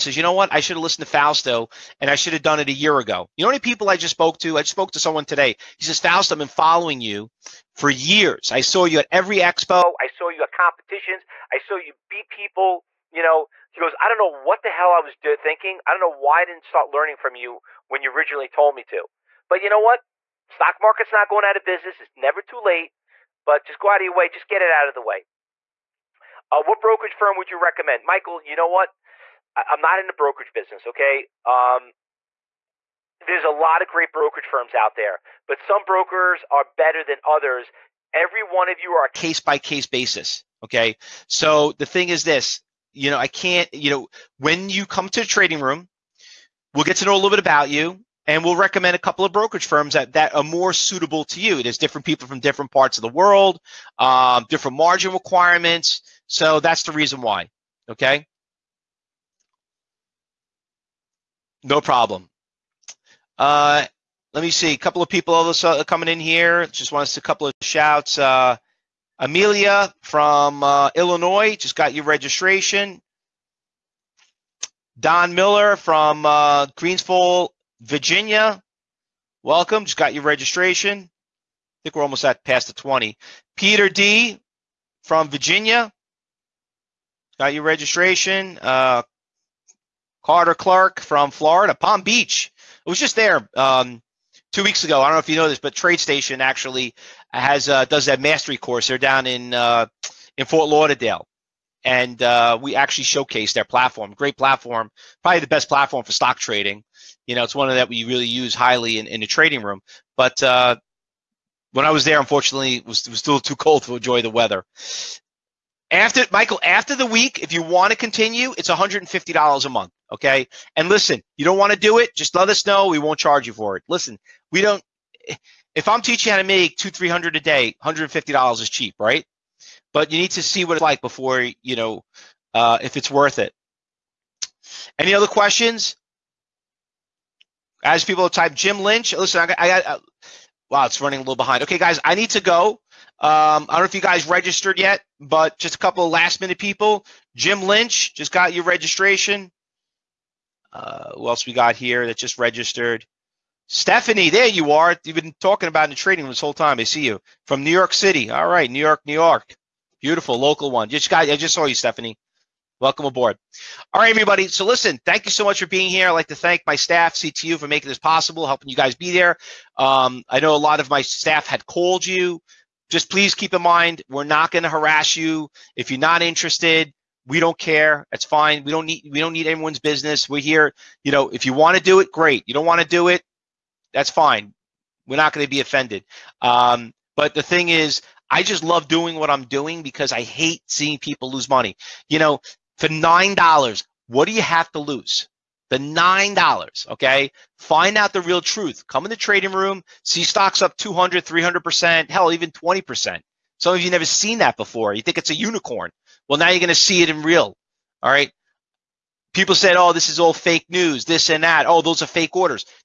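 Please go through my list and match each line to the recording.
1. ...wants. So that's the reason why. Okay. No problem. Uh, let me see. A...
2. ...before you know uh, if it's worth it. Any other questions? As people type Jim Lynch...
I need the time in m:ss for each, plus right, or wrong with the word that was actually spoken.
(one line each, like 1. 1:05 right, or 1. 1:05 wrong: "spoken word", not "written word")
1. 0:55 wrong: "requirements", not "wants"
2. 2:11 right.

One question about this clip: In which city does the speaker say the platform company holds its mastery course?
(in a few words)
Fort Lauderdale.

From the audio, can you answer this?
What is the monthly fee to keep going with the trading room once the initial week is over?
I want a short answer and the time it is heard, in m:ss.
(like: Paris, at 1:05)
$150, at 1:58.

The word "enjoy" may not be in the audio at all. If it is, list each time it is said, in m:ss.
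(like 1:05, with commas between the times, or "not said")
1:53.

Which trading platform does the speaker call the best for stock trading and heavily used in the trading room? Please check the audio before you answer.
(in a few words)
TradeStation.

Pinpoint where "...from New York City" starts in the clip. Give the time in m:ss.
2:37.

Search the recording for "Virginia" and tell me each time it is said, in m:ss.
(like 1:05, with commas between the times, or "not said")
1:17, 1:25.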